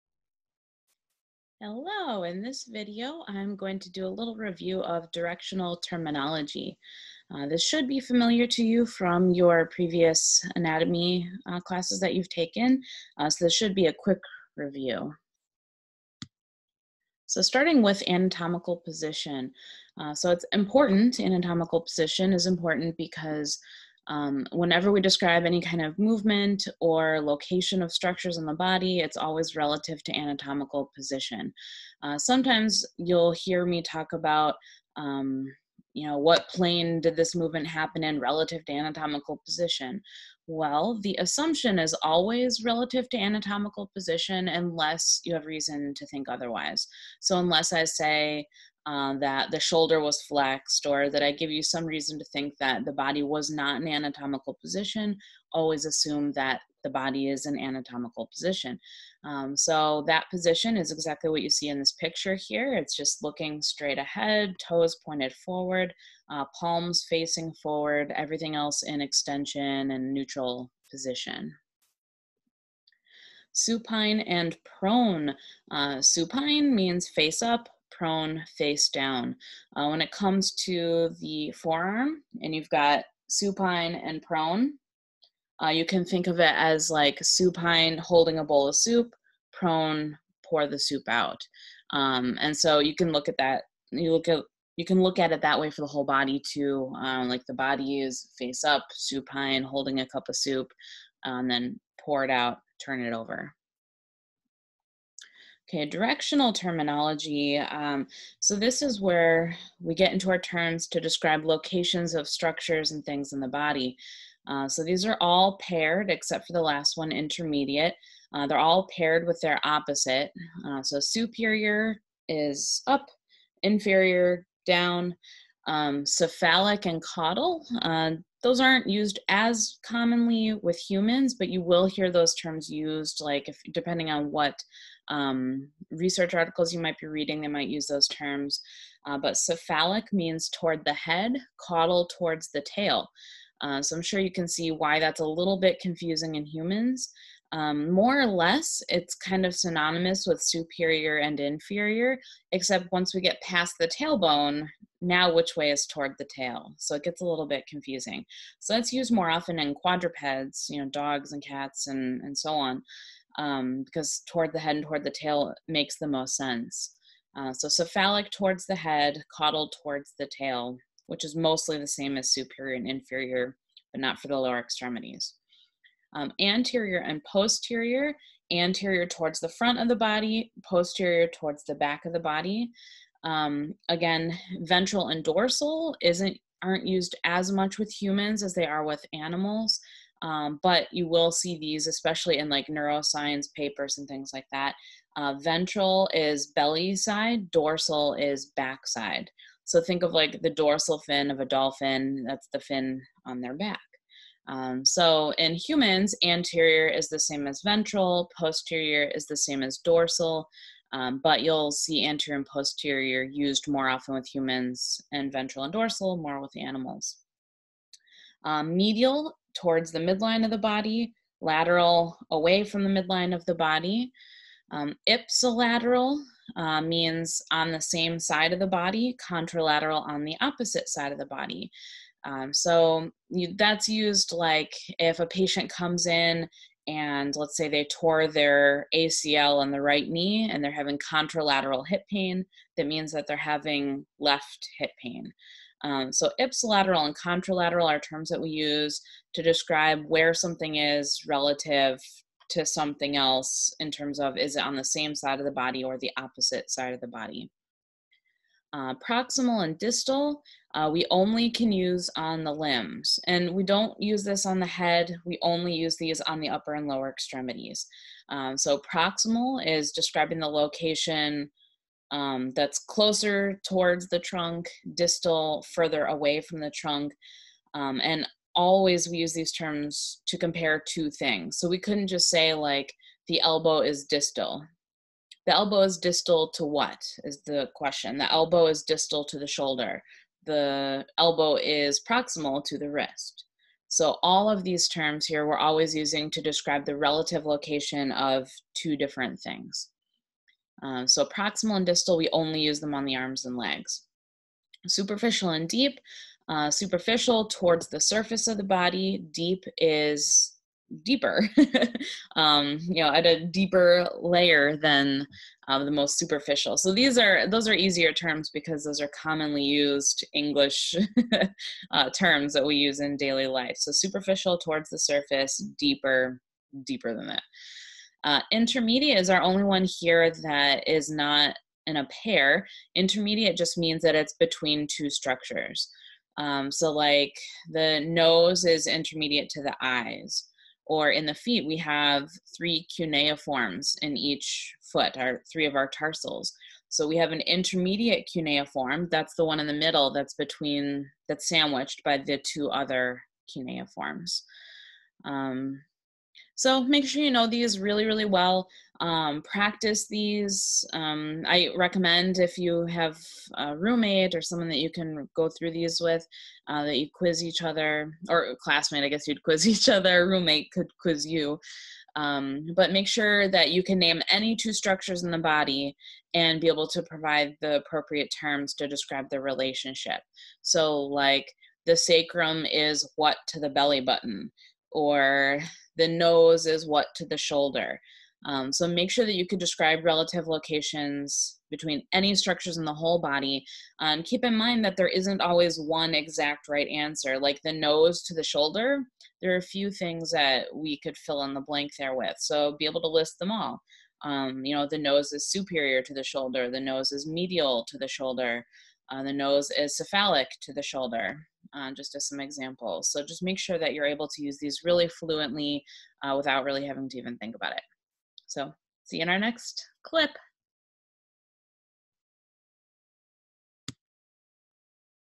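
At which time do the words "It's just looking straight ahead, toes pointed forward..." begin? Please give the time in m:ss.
1:02.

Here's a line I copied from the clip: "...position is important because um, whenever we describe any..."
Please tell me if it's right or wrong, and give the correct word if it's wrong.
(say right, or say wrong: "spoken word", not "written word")
right.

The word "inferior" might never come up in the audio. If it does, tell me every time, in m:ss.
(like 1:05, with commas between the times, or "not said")
2:03, 2:31, 2:52.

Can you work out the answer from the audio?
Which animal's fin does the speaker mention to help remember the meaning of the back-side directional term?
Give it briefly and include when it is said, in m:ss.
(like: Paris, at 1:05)
Dolphin, at 3:21.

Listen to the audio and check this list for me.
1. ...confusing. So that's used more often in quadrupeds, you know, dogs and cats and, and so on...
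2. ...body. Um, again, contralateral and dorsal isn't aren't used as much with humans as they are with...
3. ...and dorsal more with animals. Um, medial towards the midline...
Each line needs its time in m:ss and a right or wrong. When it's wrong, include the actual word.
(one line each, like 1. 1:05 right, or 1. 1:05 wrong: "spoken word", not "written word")
1. 2:37 right
2. 3:02 wrong: "ventral", not "contralateral"
3. 3:35 right.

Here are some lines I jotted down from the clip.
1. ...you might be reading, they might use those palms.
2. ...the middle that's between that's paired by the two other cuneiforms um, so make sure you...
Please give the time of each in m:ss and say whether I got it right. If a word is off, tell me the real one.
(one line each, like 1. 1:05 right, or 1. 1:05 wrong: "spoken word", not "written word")
1. 2:16 wrong: "terms", not "palms"
2. 5:49 wrong: "sandwiched", not "paired".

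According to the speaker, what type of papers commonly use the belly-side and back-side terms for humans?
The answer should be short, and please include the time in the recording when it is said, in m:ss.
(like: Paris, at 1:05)
Neuroscience papers, at 3:12.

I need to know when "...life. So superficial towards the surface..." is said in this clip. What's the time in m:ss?
5:23.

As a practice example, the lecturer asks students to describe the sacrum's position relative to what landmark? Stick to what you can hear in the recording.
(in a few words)
Belly button.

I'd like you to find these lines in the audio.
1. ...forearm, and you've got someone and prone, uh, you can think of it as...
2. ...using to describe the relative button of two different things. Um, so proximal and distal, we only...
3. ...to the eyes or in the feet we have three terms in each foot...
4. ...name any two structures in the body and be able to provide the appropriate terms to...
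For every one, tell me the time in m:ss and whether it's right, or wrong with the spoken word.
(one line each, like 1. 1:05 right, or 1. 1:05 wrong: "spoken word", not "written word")
1. 1:21 wrong: "supine", not "someone"
2. 4:55 wrong: "location", not "button"
3. 5:39 wrong: "cuneiforms", not "terms"
4. 6:13 right.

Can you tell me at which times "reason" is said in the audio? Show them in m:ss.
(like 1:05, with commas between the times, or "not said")
0:45, 0:51.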